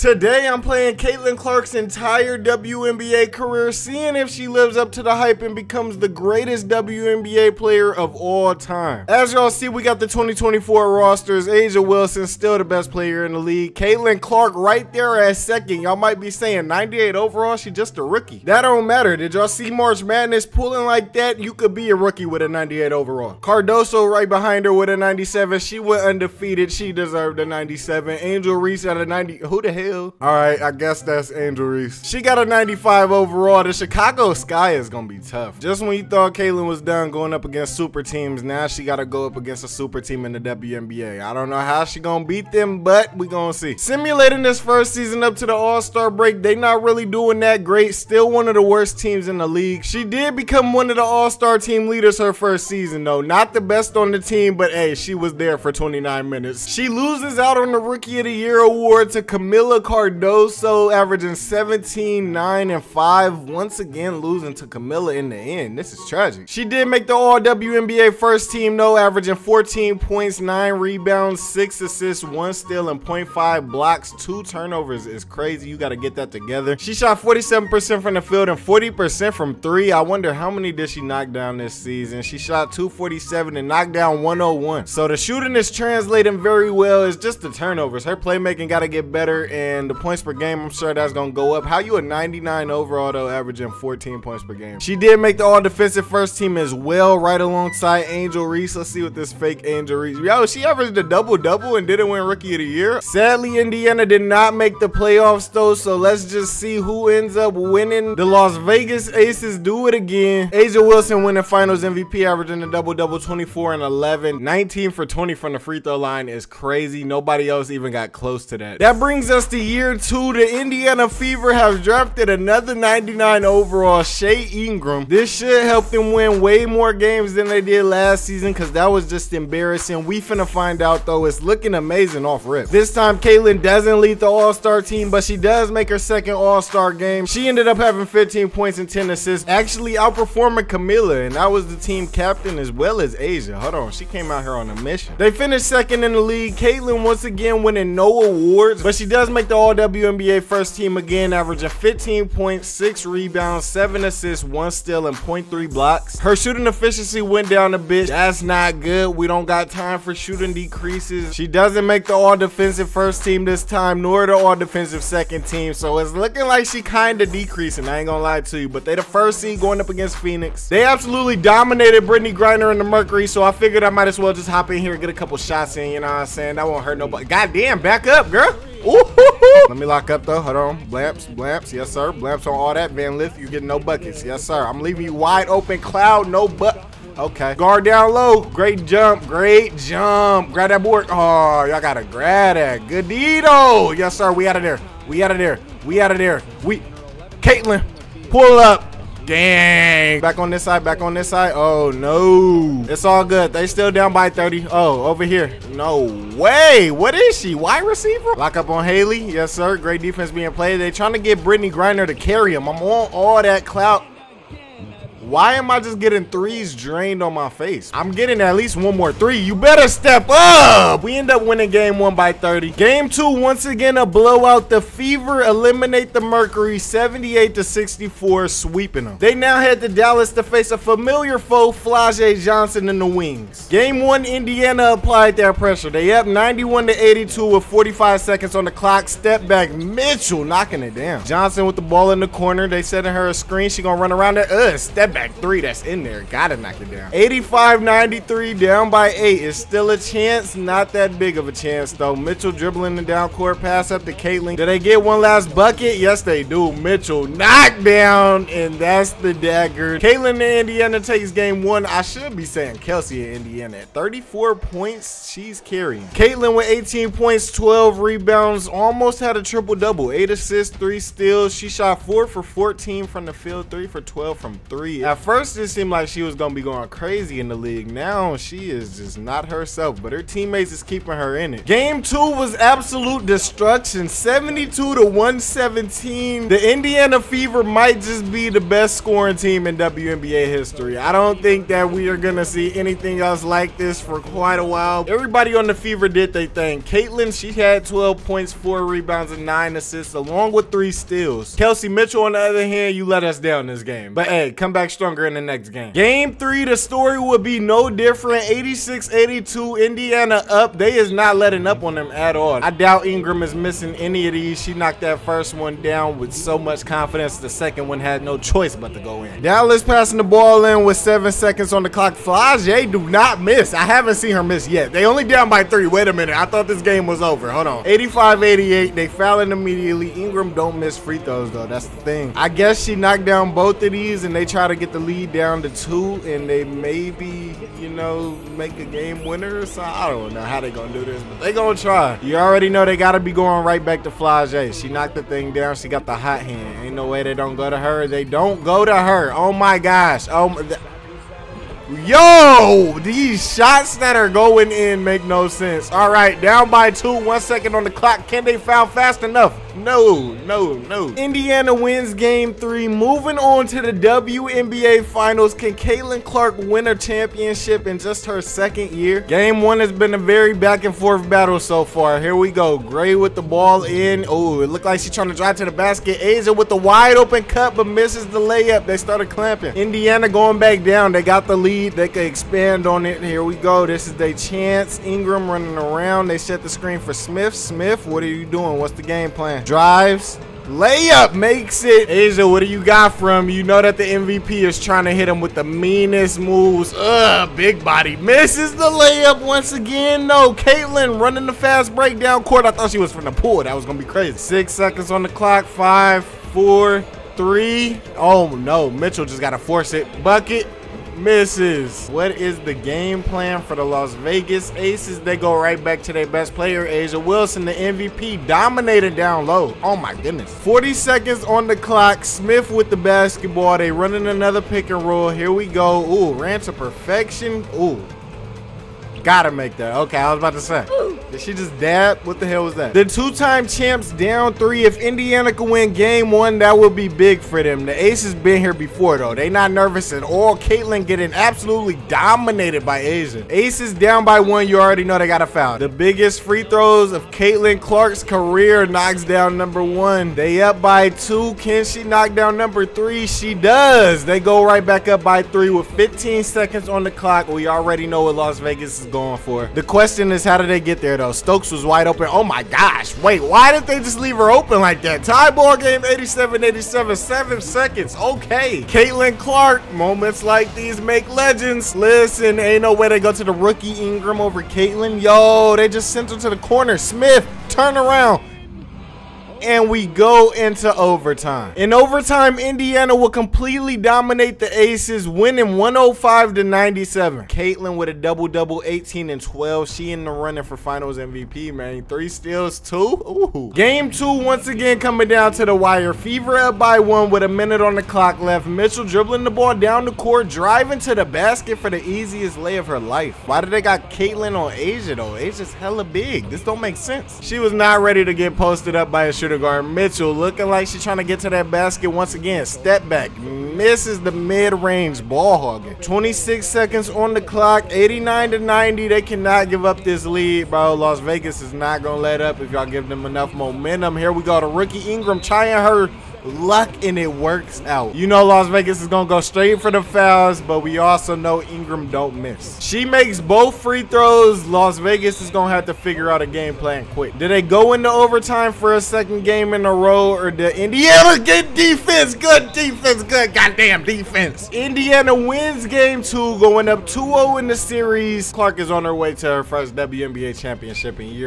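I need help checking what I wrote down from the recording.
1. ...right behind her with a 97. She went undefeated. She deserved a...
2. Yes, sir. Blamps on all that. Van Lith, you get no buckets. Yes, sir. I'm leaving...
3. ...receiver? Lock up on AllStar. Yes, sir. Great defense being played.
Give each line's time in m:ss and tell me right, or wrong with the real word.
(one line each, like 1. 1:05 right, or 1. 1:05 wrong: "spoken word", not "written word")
1. 0:24 right
2. 3:01 right
3. 3:27 wrong: "Hailey", not "AllStar".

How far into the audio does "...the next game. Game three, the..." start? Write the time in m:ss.
5:05.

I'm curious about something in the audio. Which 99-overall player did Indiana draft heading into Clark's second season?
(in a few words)
Shea Ingram.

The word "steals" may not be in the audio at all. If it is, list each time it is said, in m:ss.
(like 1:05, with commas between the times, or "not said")
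1:12, 2:34, 4:31, 5:00, 8:12.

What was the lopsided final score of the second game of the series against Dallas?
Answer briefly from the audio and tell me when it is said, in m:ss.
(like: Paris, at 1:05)
72 to 117, at 4:44.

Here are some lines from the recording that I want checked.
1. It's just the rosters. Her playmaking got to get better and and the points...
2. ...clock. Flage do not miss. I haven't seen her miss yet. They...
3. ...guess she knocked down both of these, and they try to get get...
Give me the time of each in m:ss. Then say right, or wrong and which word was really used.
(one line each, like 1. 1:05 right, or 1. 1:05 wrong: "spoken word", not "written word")
1. 1:27 wrong: "turnovers", not "rosters"
2. 5:21 right
3. 5:32 right.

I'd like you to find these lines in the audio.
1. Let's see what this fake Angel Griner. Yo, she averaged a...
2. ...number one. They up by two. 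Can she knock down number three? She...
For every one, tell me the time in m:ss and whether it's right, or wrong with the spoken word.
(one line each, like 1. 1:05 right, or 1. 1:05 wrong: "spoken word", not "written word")
1. 1:38 wrong: "Reese", not "Griner"
2. 7:29 right.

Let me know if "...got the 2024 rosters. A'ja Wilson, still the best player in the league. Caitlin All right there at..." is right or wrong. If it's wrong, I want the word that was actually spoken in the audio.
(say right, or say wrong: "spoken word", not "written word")
wrong: "Clark", not "All".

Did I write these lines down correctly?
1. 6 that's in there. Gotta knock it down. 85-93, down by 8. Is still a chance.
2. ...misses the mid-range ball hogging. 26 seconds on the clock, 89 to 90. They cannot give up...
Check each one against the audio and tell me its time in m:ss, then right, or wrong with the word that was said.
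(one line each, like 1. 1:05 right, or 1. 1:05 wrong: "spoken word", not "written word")
1. 4:05 wrong: "3", not "6"
2. 8:33 right.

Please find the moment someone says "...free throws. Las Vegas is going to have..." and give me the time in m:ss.
8:53.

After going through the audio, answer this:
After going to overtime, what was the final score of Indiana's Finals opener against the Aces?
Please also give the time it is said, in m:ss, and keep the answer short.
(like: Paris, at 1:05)
105 to 97, at 8:05.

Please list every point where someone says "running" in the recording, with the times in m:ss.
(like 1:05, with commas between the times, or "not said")
6:25, 6:41, 7:03, 8:10.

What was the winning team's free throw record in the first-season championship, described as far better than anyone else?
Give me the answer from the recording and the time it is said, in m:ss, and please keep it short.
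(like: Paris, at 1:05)
19 for 20, at 1:54.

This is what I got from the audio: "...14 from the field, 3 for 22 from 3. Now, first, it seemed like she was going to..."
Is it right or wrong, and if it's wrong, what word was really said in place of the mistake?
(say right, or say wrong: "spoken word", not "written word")
wrong: "12", not "22".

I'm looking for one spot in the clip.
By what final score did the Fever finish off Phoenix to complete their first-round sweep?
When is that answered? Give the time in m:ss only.
3:46.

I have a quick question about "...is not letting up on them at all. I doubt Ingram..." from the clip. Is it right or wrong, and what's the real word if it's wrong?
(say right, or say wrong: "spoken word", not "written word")
right.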